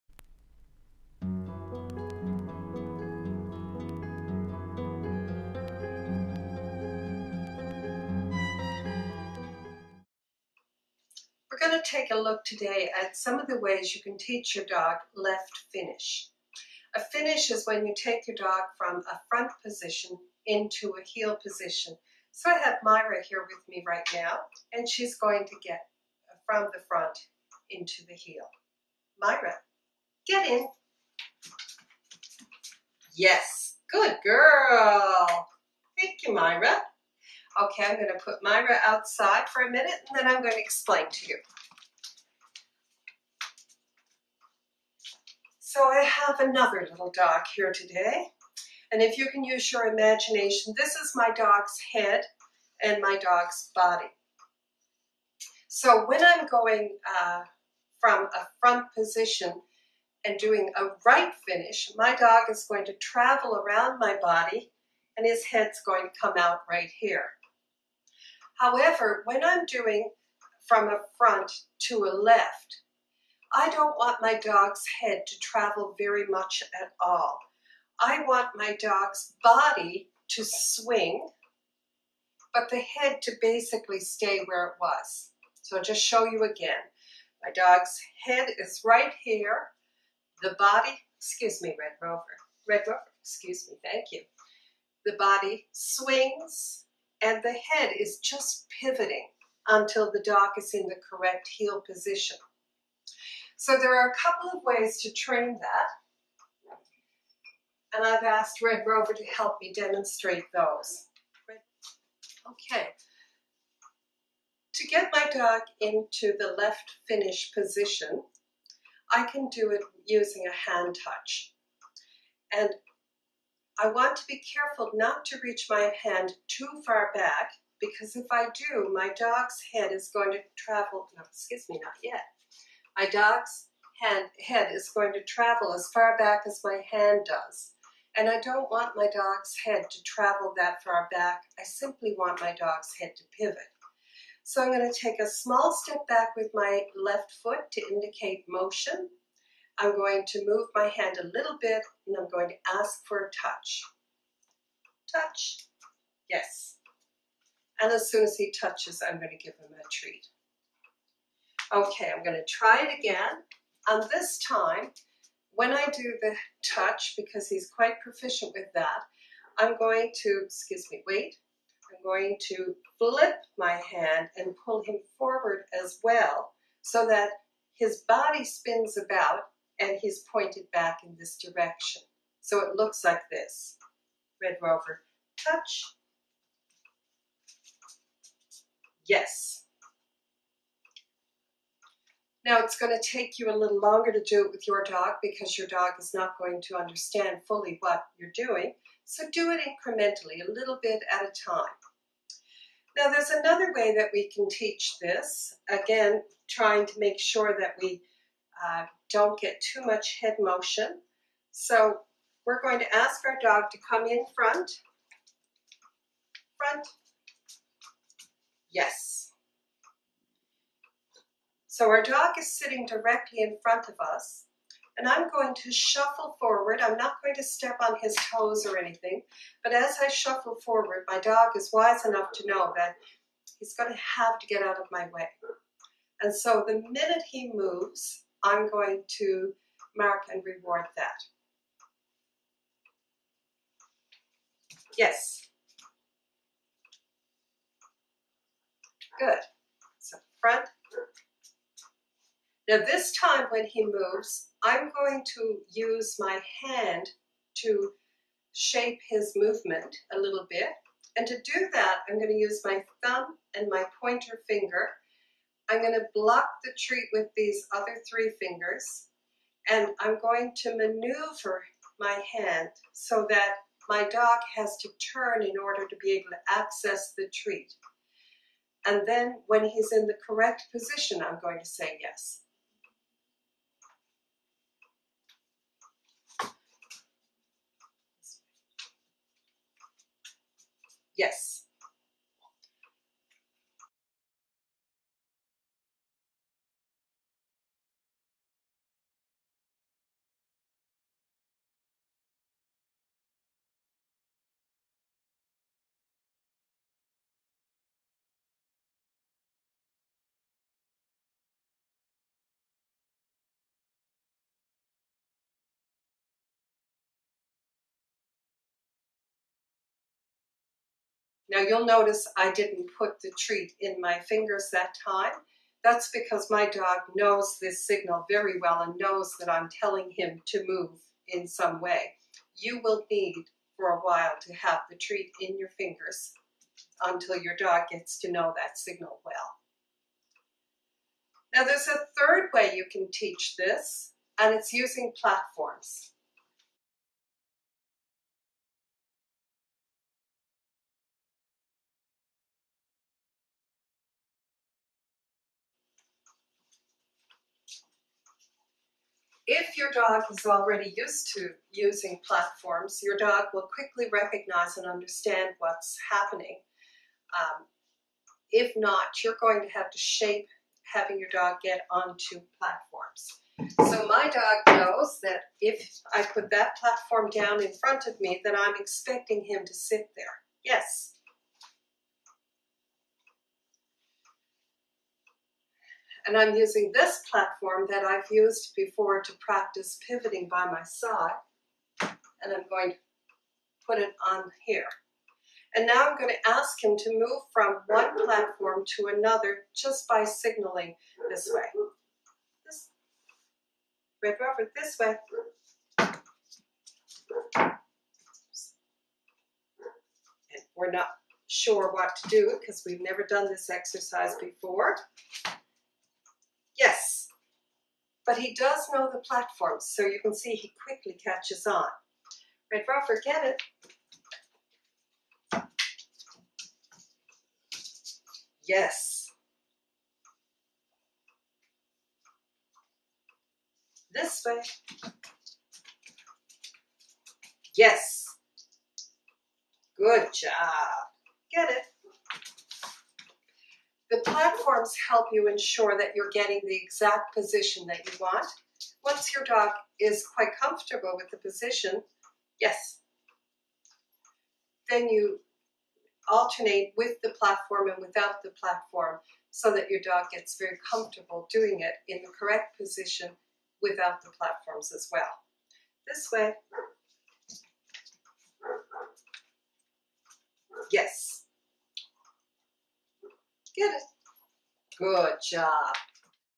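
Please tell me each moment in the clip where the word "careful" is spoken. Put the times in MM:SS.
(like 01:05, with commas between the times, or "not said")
02:04.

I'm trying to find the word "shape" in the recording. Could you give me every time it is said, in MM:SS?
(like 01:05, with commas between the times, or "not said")
04:18, 06:09.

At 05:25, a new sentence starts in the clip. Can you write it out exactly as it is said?
That's because my dog knows this signal very well and knows that I'm telling him to move in some way.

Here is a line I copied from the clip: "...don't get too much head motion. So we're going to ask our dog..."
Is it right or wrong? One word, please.
right.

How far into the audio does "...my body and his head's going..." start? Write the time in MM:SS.
01:03.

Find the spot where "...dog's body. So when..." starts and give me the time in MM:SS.
00:53.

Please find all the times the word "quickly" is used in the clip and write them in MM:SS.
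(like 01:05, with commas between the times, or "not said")
06:03, 07:00.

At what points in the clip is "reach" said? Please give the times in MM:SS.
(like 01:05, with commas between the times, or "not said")
02:05.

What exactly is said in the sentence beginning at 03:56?
And so the minute he moves, I'm going to mark and reward that.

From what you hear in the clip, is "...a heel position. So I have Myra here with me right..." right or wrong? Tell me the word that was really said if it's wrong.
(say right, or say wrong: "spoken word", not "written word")
right.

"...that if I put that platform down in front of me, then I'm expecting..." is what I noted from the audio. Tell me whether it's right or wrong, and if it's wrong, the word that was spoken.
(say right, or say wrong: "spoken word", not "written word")
right.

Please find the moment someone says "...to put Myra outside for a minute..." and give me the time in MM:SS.
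00:38.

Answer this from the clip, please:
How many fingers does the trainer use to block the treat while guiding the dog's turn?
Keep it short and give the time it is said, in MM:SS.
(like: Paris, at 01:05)
3, at 04:28.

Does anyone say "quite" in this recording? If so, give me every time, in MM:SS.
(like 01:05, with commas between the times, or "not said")
02:47, 07:30.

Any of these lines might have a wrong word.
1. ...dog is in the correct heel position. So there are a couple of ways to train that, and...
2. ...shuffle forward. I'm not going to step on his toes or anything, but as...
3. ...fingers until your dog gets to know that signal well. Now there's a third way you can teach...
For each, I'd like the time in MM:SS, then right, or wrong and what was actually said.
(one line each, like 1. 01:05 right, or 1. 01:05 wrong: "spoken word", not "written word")
1. 01:40 right
2. 03:45 right
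3. 05:35 right.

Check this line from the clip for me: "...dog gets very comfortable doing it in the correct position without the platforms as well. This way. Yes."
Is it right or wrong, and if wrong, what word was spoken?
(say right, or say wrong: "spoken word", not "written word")
right.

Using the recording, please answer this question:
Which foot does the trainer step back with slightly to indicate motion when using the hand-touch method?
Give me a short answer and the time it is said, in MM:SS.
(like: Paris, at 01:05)
Left foot, at 02:27.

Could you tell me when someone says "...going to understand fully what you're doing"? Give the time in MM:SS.
03:16.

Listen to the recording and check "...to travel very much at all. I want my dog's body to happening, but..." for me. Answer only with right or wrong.
wrong.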